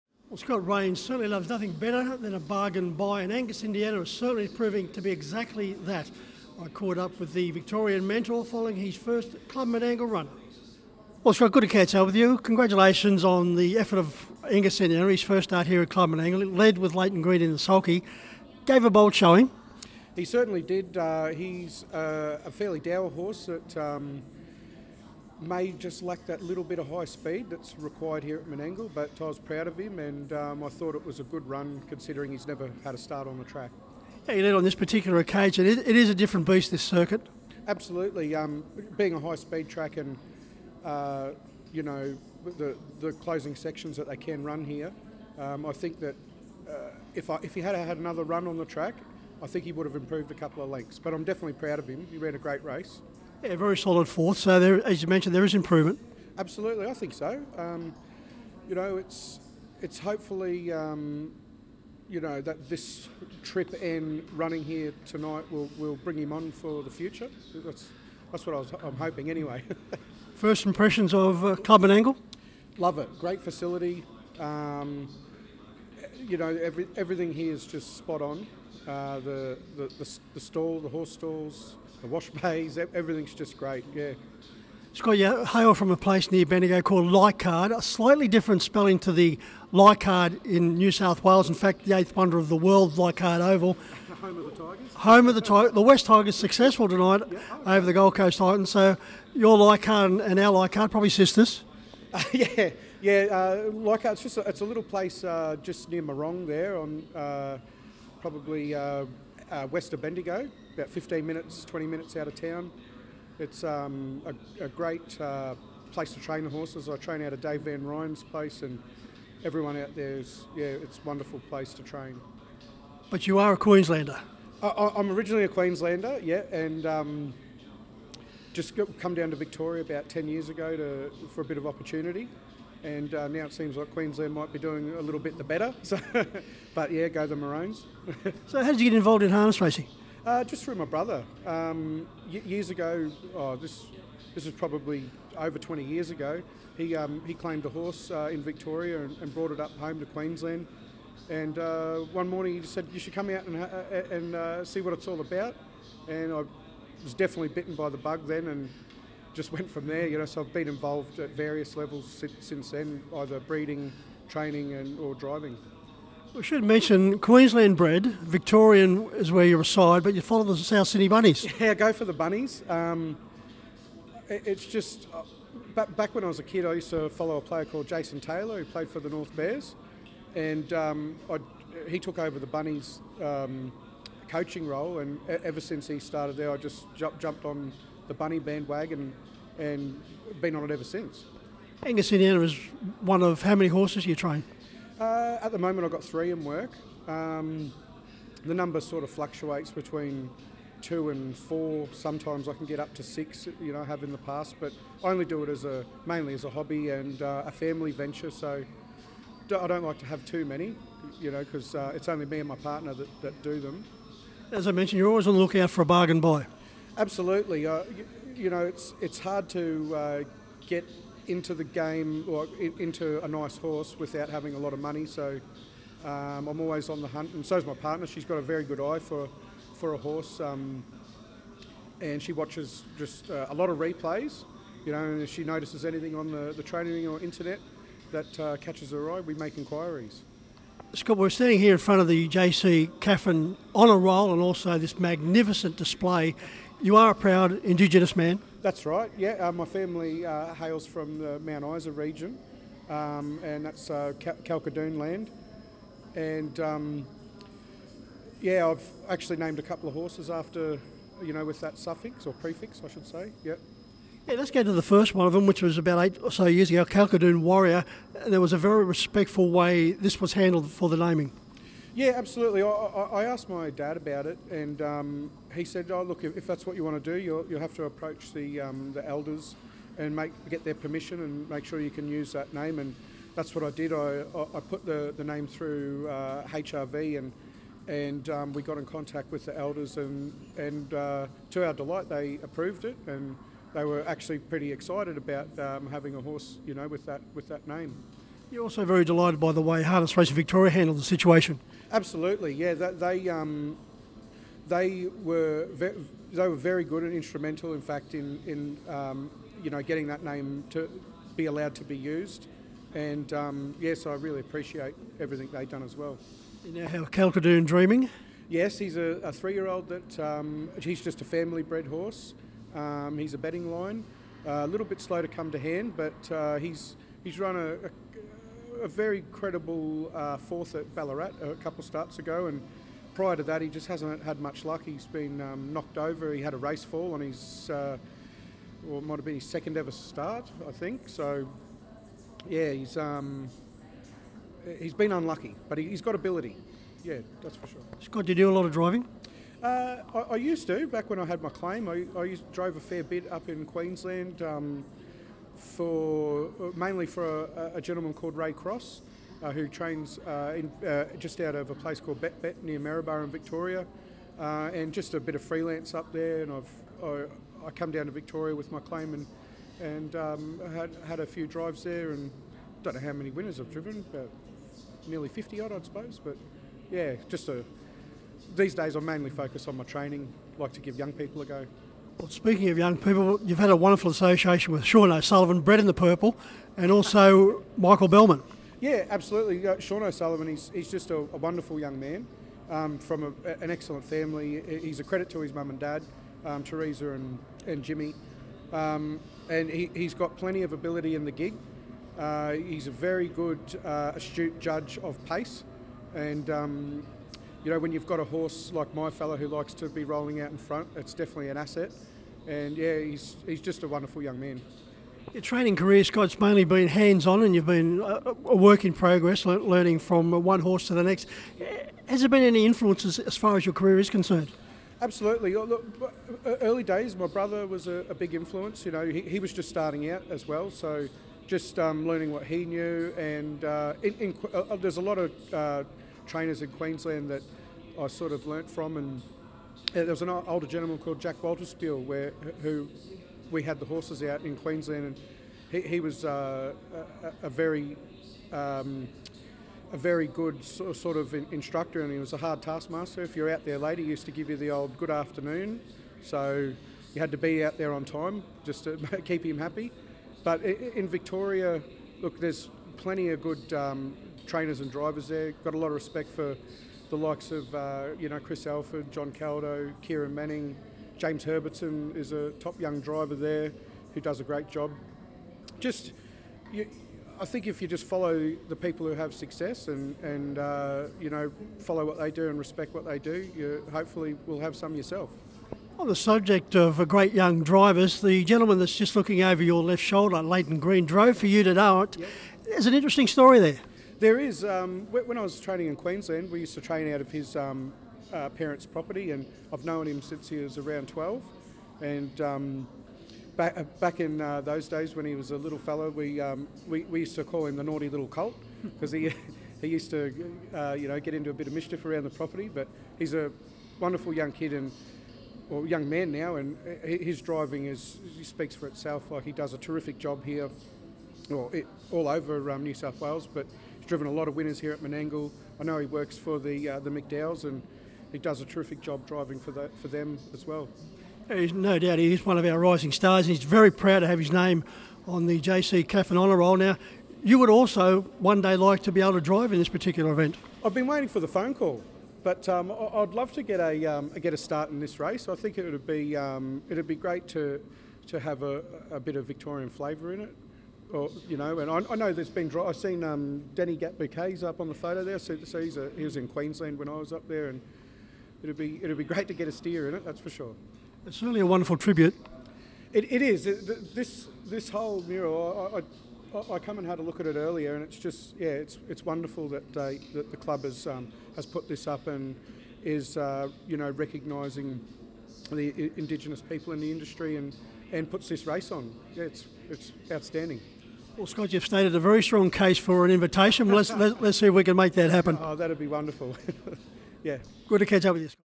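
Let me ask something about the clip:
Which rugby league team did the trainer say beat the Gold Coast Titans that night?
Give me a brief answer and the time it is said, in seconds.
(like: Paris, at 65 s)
West Tigers, at 95 s.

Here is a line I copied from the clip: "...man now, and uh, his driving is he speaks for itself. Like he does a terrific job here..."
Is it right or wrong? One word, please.
right.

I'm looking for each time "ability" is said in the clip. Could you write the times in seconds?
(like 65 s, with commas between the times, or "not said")
346 s, 400 s.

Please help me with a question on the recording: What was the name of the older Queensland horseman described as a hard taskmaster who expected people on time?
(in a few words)
Jack Walterspiel.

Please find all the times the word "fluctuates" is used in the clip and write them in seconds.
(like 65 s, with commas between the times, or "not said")
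199 s.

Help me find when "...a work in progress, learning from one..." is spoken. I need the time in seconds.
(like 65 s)
418 s.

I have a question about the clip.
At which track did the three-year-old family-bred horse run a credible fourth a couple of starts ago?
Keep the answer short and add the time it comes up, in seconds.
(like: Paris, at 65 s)
Ballarat, at 330 s.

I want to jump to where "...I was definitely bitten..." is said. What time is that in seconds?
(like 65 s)
156 s.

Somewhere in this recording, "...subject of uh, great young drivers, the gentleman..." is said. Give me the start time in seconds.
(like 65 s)
486 s.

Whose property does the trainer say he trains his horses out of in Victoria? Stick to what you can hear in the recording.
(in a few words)
Dave Van Ryan.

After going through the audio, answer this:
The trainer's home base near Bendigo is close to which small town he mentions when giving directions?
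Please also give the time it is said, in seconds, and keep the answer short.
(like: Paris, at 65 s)
Marong, at 106 s.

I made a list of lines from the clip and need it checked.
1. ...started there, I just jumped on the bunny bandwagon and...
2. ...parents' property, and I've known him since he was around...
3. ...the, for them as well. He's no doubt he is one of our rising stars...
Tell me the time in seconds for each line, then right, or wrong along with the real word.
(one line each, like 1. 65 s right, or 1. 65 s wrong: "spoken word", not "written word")
1. 185 s right
2. 498 s right
3. 529 s right.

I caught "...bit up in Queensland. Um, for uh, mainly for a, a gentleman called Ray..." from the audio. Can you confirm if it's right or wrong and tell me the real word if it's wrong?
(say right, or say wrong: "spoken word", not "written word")
right.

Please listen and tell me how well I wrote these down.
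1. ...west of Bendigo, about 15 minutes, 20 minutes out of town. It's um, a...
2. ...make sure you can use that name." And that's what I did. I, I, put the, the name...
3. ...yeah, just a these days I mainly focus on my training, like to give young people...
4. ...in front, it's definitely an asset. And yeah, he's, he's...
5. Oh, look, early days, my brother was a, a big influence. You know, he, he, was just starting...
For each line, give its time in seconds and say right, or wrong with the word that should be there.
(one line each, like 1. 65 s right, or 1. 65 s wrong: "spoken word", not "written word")
1. 109 s right
2. 281 s right
3. 376 s right
4. 410 s right
5. 425 s right.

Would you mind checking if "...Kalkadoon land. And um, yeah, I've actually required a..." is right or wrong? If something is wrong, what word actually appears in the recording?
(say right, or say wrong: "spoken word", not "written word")
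wrong: "named", not "required".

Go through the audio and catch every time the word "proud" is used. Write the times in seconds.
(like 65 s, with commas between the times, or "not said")
29 s, 51 s, 247 s, 533 s.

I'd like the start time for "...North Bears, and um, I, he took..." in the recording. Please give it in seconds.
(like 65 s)
179 s.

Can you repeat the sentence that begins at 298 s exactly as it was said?
You're also very delighted by the way Harness Racing Victoria handled the situation.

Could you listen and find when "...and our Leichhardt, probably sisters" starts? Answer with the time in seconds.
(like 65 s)
100 s.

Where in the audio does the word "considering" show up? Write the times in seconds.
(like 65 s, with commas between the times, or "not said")
31 s.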